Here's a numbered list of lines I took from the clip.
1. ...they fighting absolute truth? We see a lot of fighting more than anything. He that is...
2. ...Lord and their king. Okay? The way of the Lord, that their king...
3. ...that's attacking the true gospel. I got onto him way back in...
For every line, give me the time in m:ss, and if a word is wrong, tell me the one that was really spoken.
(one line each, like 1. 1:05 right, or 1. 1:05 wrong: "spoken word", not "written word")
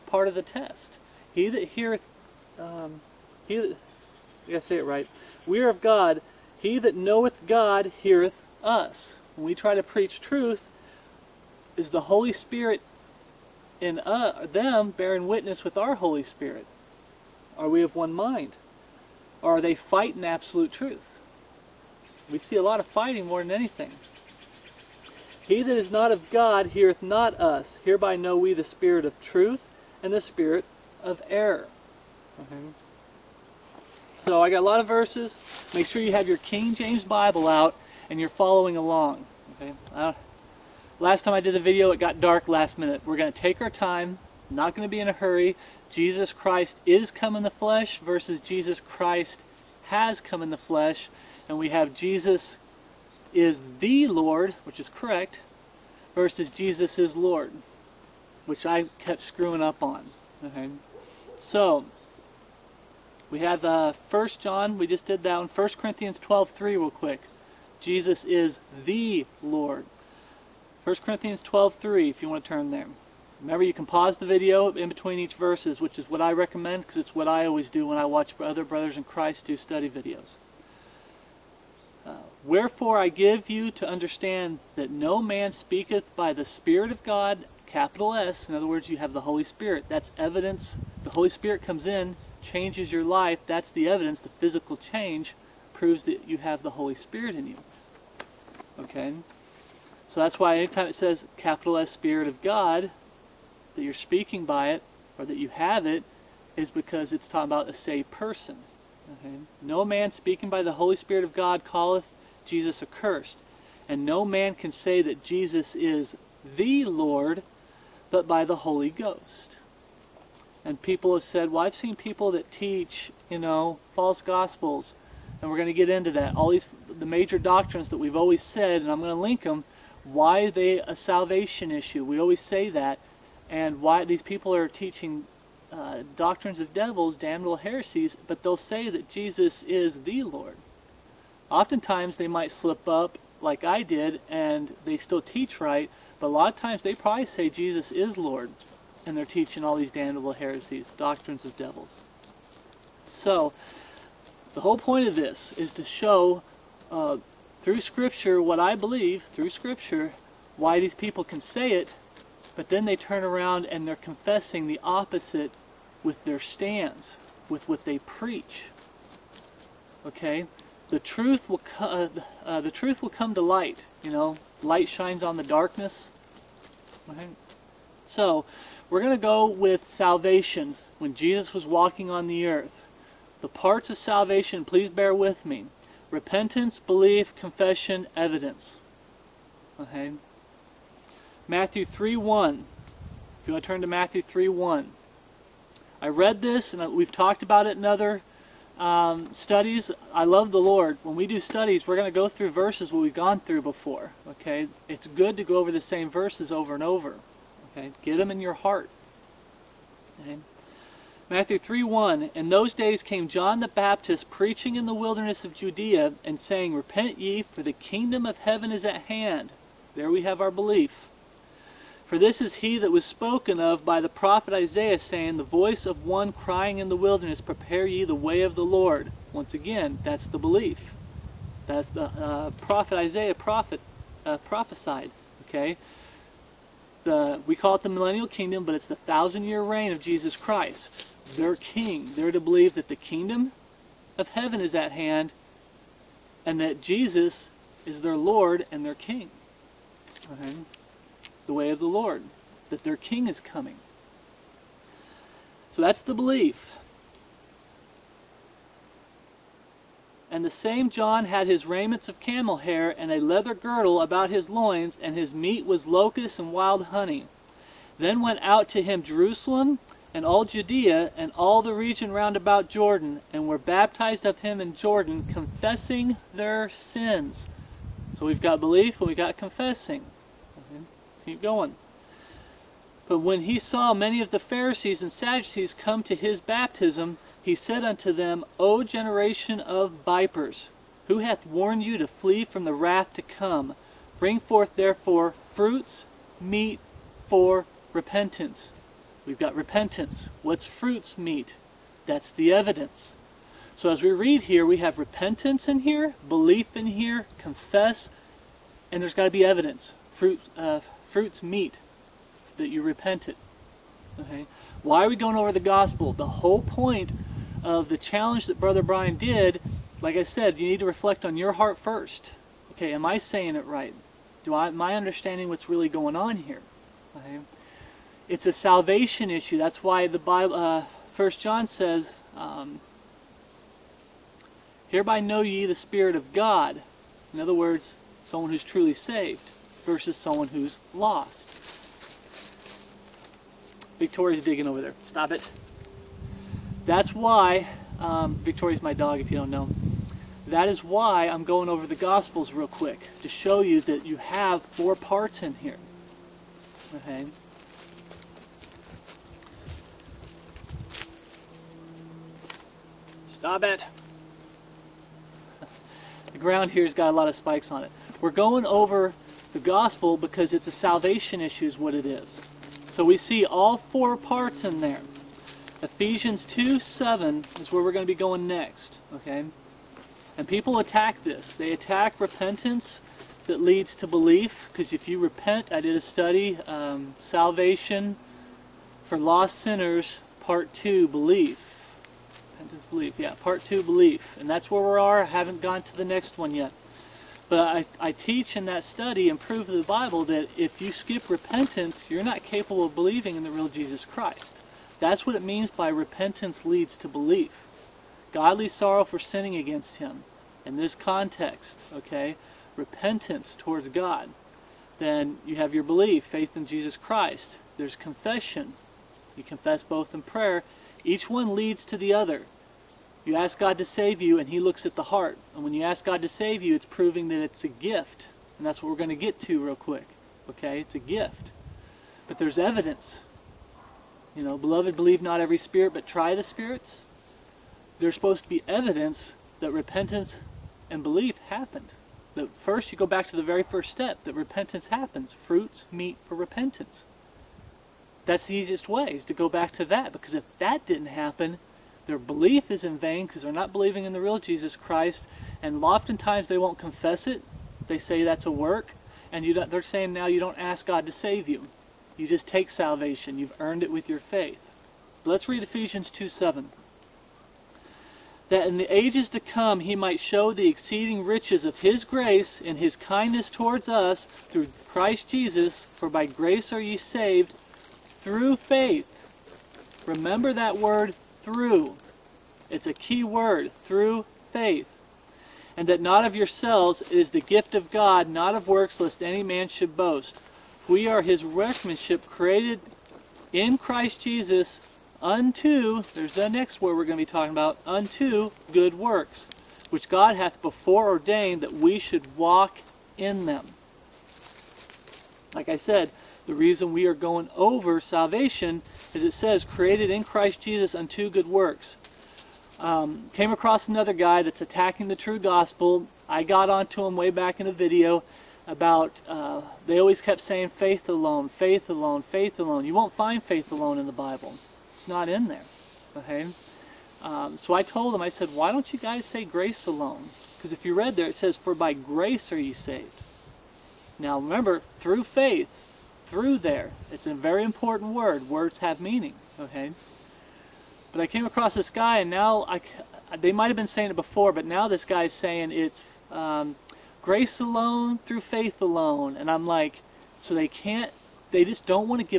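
1. 0:19 right
2. 4:08 right
3. 8:34 right.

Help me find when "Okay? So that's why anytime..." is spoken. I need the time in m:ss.
1:38.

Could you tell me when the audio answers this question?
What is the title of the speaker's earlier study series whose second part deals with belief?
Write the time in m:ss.
6:27.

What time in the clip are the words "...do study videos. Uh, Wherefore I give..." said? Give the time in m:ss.
1:19.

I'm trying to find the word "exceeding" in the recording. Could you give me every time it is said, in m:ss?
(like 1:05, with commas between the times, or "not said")
7:50.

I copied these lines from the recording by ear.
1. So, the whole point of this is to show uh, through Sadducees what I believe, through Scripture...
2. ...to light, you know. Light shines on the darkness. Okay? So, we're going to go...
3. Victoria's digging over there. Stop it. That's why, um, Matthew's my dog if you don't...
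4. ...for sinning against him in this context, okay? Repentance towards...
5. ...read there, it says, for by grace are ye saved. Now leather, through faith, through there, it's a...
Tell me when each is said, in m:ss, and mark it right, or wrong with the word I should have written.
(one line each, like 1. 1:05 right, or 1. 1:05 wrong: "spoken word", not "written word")
1. 2:33 wrong: "Scripture", not "Sadducees"
2. 2:53 right
3. 5:43 wrong: "Victoria", not "Matthew"
4. 6:49 right
5. 8:50 wrong: "remember", not "leather".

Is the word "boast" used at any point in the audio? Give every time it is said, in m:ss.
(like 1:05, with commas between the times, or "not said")
8:09.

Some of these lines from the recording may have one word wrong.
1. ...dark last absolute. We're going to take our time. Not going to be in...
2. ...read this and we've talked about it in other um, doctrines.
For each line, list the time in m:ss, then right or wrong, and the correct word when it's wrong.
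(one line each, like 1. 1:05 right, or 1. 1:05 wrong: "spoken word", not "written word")
1. 0:42 wrong: "minute", not "absolute"
2. 3:16 wrong: "studies", not "doctrines".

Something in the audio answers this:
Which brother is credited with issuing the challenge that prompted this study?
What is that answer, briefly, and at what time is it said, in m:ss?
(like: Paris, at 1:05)
Brian, at 5:18.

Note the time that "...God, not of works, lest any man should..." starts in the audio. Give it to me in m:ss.
8:07.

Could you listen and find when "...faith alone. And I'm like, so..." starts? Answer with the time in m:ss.
9:08.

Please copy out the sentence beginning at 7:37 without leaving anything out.
They say that's a work, and you they're saying now you don't ask God to save you.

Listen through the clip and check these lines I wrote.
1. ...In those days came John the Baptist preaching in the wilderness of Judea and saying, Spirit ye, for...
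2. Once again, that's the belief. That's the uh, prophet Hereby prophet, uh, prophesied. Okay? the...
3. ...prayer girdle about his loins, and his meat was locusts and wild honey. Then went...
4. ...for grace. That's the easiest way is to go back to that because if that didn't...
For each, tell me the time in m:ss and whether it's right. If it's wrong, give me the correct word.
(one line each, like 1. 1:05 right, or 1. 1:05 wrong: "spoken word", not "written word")
1. 3:32 wrong: "Repent", not "Spirit"
2. 3:49 wrong: "Isaiah", not "Hereby"
3. 4:23 wrong: "leather", not "prayer"
4. 7:26 wrong: "repentance", not "grace".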